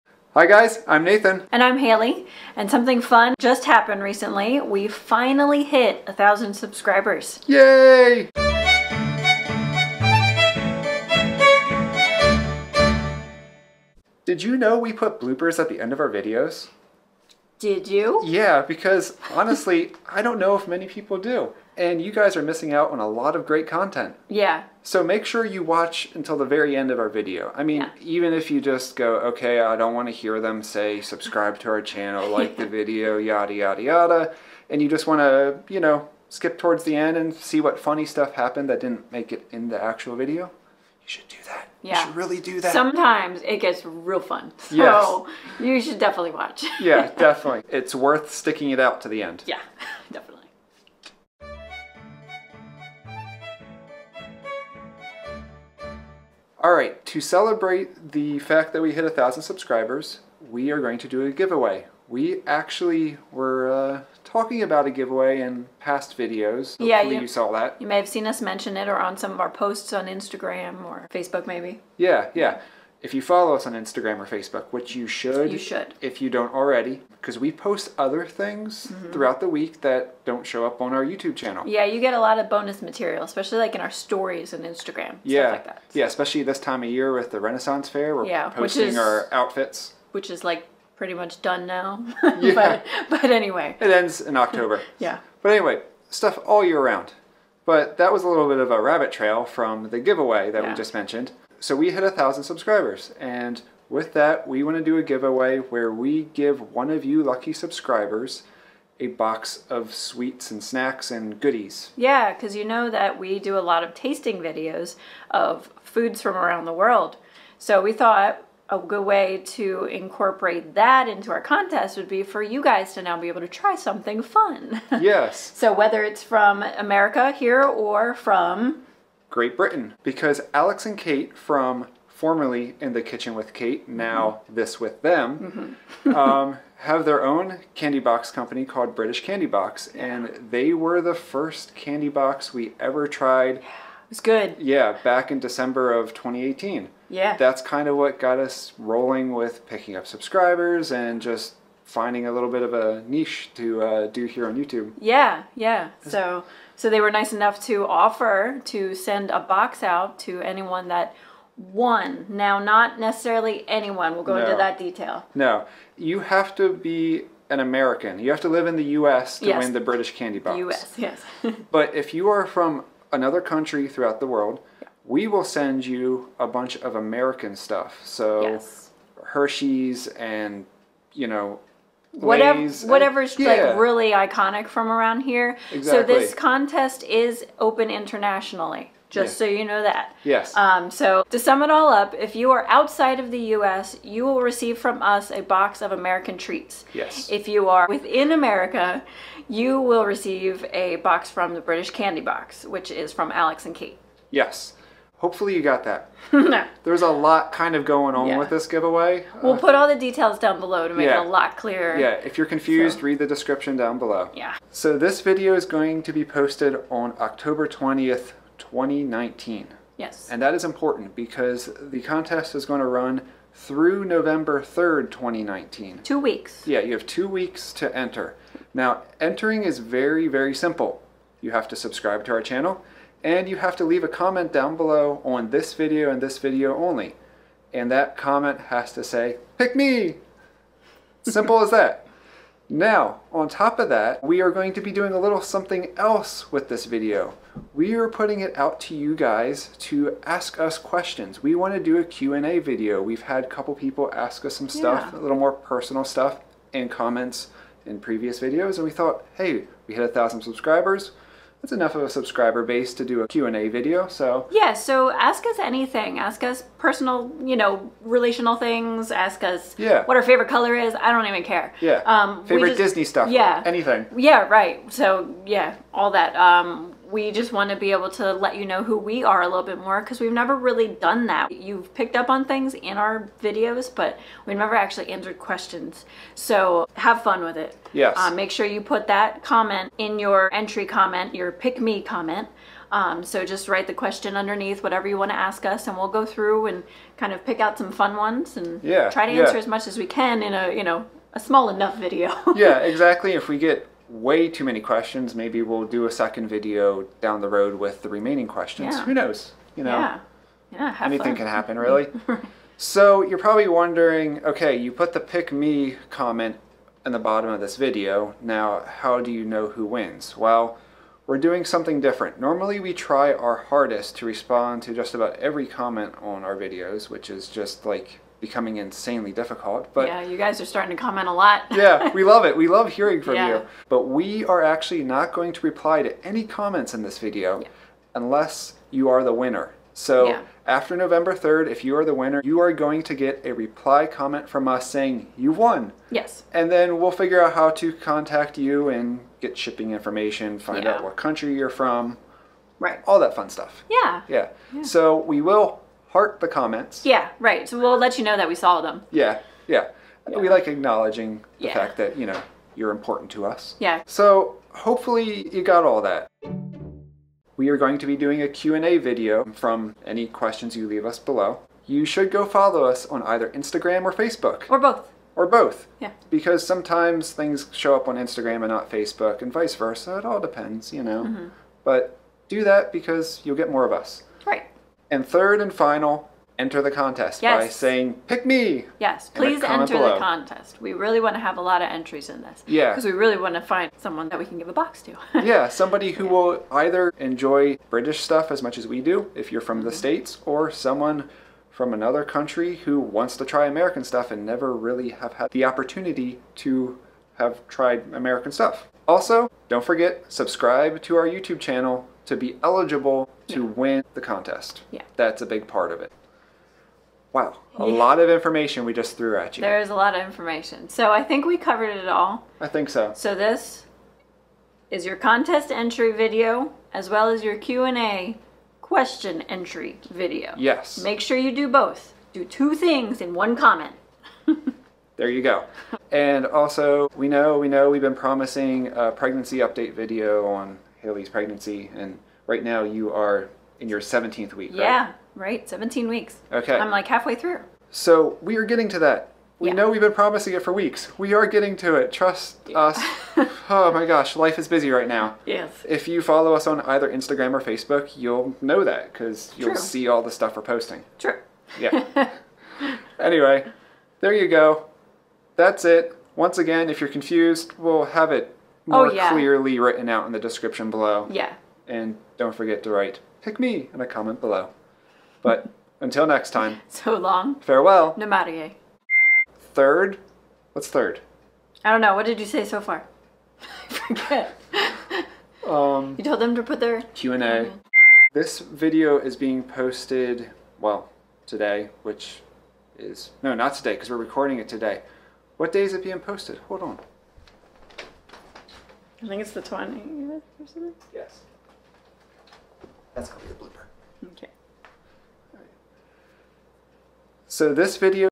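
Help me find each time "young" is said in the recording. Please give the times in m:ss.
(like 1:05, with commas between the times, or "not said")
not said.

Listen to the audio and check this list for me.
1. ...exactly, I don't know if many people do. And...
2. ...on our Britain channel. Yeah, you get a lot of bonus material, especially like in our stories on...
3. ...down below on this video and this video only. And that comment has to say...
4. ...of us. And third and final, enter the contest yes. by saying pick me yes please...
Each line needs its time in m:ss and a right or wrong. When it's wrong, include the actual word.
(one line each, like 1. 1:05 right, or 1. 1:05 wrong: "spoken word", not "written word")
1. 0:19 wrong: "honestly", not "exactly"
2. 1:20 wrong: "YouTube", not "Britain"
3. 3:54 right
4. 6:23 right.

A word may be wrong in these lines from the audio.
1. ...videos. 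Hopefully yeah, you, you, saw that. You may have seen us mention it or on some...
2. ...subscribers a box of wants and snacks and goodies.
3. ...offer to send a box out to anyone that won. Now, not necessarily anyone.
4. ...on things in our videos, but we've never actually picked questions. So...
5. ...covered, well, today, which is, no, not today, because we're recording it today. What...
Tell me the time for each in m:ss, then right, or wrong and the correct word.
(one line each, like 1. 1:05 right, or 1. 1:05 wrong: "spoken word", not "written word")
1. 1:06 right
2. 1:47 wrong: "sweets", not "wants"
3. 2:37 right
4. 4:42 wrong: "answered", not "picked"
5. 8:09 wrong: "posted", not "covered".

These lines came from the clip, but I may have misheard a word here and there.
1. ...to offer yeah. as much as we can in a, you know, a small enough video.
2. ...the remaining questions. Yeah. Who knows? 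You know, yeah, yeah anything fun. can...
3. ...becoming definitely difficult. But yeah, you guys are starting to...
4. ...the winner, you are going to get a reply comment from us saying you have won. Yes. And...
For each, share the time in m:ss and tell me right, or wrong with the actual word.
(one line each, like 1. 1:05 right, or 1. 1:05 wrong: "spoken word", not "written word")
1. 4:59 wrong: "answer", not "offer"
2. 5:08 right
3. 5:28 wrong: "insanely", not "definitely"
4. 5:42 right.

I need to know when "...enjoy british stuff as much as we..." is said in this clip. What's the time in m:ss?
6:37.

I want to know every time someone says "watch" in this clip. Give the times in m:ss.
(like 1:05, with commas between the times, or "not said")
0:25, 0:46.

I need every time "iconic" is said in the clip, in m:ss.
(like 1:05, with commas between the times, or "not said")
3:04.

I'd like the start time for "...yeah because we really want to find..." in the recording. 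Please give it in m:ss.
6:32.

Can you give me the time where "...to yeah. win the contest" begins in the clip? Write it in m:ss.
6:53.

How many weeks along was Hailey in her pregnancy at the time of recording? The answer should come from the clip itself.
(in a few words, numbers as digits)
17.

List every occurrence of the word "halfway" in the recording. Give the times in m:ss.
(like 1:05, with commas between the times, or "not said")
7:27.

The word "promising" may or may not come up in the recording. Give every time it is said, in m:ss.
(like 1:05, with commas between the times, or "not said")
7:18, 7:30.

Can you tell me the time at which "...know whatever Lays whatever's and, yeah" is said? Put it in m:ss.
3:01.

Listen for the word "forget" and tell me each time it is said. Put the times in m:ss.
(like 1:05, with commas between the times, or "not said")
6:49, 7:52, 8:03.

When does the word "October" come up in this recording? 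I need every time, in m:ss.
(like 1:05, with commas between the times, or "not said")
1:34, 3:37.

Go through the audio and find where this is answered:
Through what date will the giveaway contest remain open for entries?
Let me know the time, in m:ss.
3:44.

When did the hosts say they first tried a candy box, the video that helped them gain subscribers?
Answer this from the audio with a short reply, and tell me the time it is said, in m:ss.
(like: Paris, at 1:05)
December 2018, at 2:25.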